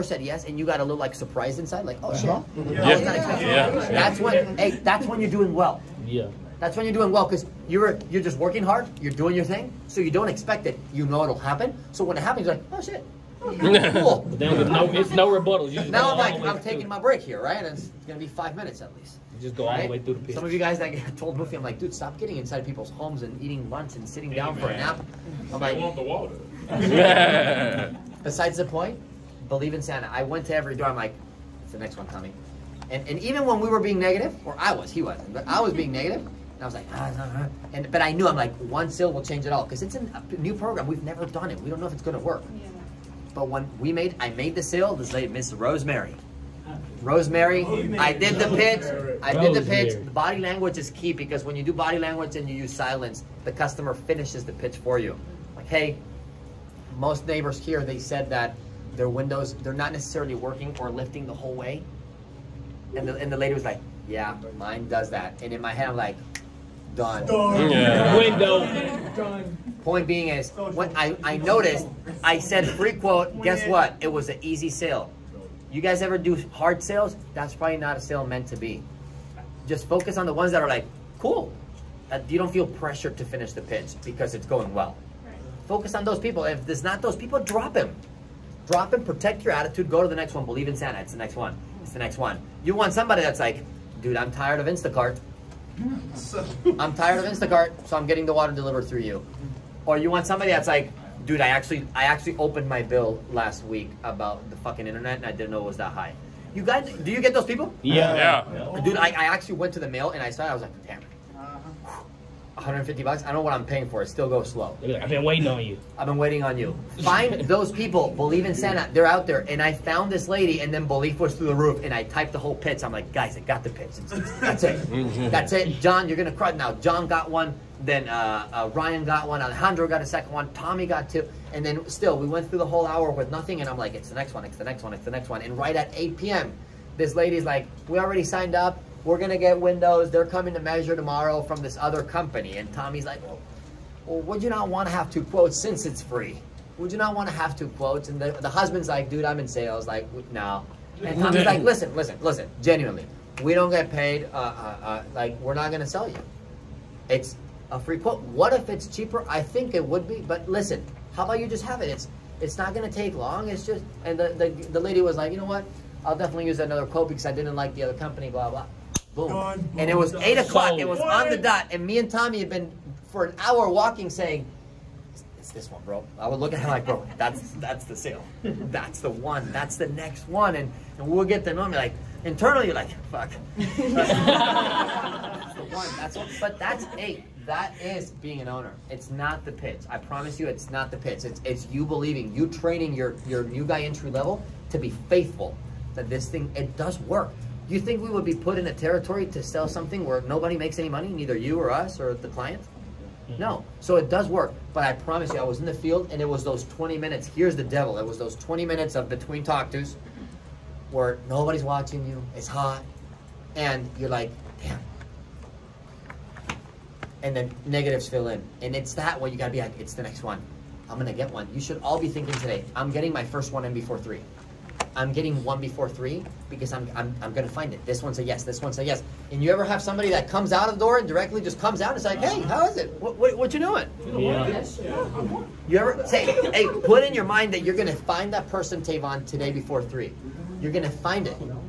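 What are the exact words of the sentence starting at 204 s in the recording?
But I promise you, I was in the field and it was those 20 minutes.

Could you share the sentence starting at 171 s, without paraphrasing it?
And me and Tommy had been, for an hour, walking saying, it's this one, bro.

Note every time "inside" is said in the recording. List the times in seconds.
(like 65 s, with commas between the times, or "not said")
1 s, 22 s.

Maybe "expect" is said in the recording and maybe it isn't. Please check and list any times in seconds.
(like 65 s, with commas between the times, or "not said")
10 s.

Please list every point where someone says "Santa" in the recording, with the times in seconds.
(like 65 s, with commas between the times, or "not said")
29 s, 90 s, 118 s.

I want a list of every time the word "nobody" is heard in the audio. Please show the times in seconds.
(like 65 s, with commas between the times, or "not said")
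200 s, 211 s.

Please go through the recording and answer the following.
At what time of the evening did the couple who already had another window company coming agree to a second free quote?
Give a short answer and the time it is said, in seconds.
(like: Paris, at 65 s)
8 p.m., at 135 s.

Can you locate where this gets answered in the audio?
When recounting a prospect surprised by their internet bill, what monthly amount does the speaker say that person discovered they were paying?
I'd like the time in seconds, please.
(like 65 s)
112 s.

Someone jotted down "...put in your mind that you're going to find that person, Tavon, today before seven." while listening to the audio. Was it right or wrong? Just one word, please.
wrong.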